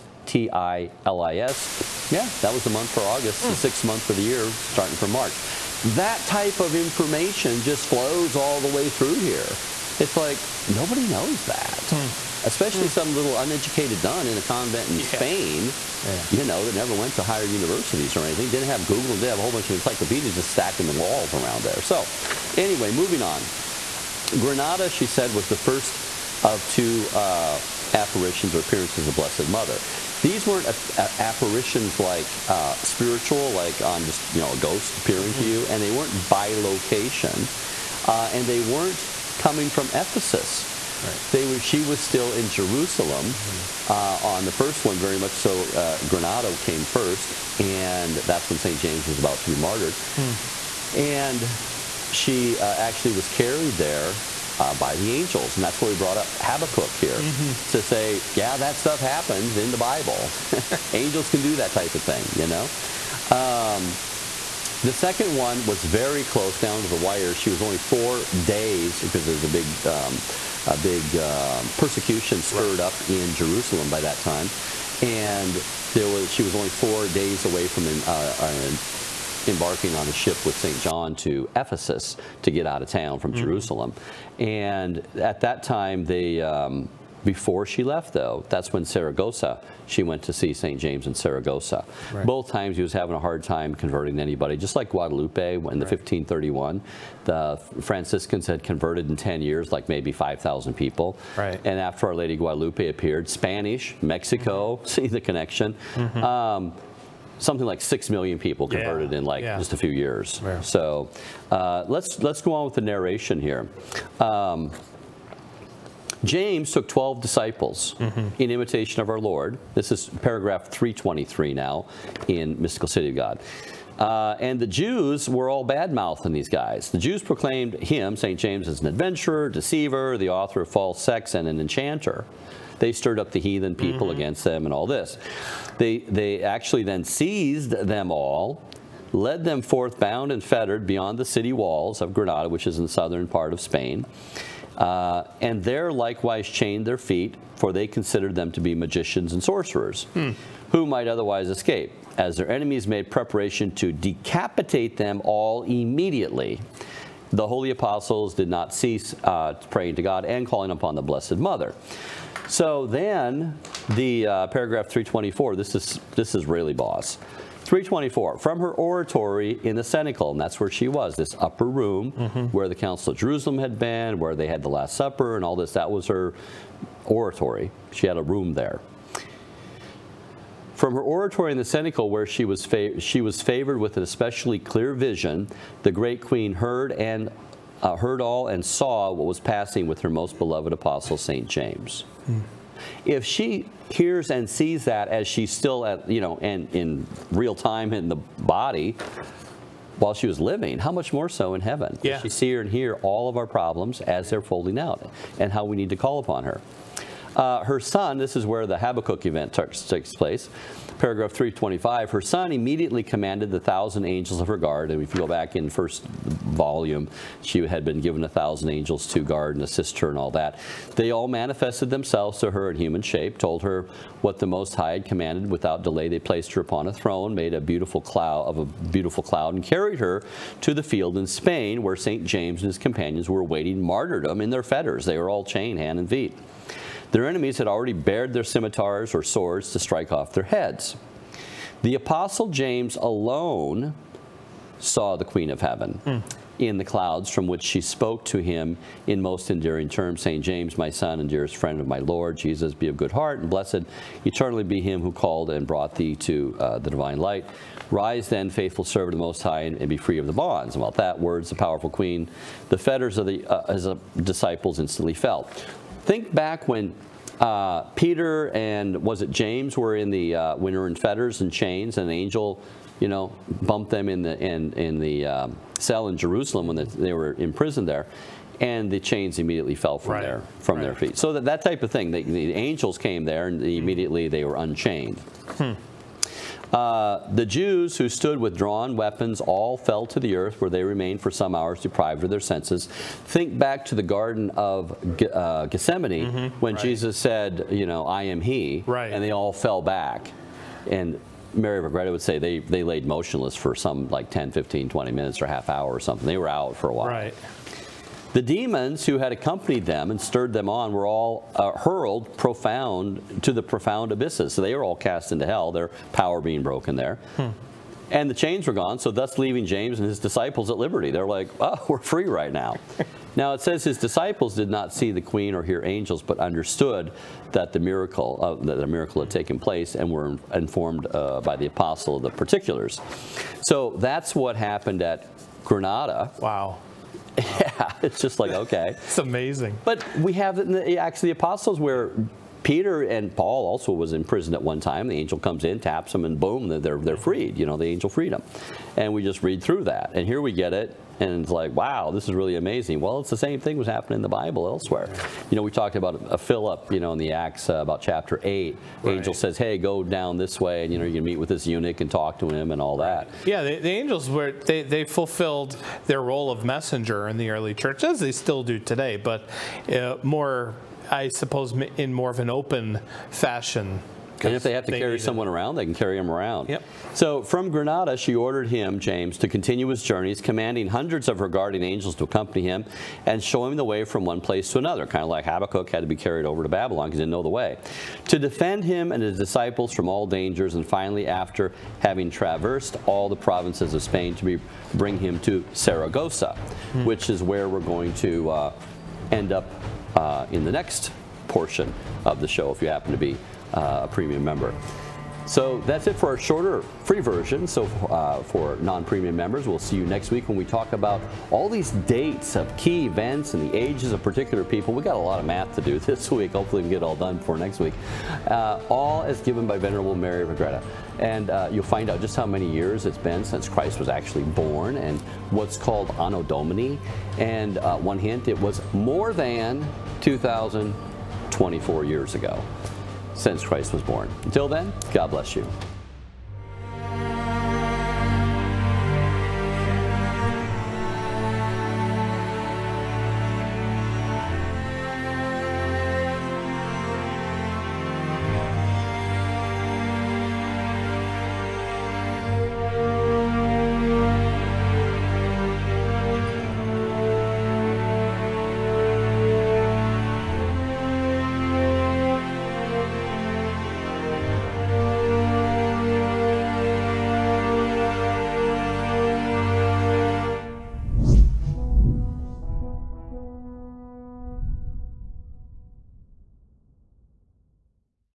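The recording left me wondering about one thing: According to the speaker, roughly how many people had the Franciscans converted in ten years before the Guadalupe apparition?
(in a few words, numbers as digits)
5,000.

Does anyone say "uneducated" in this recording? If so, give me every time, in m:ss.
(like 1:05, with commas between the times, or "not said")
0:13.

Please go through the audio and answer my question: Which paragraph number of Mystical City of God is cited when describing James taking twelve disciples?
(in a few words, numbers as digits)
323.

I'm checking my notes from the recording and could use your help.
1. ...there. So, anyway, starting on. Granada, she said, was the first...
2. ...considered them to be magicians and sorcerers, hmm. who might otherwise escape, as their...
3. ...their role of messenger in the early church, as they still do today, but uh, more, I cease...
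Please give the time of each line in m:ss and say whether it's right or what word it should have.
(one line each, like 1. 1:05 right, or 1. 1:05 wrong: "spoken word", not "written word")
1. 0:21 wrong: "moving", not "starting"
2. 2:27 right
3. 6:06 wrong: "suppose", not "cease".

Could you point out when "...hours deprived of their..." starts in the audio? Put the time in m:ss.
4:51.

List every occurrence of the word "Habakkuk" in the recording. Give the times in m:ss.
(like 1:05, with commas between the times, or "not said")
0:56, 3:28, 6:25.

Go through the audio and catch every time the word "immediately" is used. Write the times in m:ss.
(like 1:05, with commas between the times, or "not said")
2:35, 3:32, 4:39, 4:43.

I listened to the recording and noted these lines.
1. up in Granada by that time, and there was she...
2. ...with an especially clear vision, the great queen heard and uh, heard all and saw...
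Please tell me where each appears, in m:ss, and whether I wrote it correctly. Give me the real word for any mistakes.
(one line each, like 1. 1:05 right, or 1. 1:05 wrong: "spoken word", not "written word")
1. 1:12 wrong: "Jerusalem", not "Granada"
2. 3:03 right.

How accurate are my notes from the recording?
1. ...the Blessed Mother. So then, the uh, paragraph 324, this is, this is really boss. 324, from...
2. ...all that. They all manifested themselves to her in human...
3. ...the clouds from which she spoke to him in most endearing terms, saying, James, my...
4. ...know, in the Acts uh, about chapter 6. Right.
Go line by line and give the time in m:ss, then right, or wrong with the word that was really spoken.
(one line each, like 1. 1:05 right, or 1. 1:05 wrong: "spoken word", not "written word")
1. 2:40 right
2. 3:40 right
3. 4:06 right
4. 5:56 wrong: "8", not "6".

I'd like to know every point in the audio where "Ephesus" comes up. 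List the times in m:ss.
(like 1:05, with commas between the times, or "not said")
0:39, 1:21.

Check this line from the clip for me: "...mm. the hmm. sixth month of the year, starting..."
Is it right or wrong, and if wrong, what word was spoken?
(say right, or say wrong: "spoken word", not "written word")
right.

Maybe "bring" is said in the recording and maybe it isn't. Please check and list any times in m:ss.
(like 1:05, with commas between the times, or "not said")
6:34.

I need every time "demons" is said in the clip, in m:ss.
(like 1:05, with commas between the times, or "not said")
5:08.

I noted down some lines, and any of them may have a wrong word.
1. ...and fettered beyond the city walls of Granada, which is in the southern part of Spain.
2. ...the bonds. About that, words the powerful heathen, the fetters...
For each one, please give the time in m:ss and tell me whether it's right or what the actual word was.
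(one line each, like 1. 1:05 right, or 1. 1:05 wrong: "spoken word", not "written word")
1. 2:20 right
2. 4:20 wrong: "queen", not "heathen".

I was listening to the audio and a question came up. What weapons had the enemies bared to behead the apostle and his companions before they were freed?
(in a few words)
scimitars.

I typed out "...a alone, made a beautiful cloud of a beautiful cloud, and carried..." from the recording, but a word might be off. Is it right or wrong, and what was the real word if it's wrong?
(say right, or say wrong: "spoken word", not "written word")
wrong: "throne", not "alone".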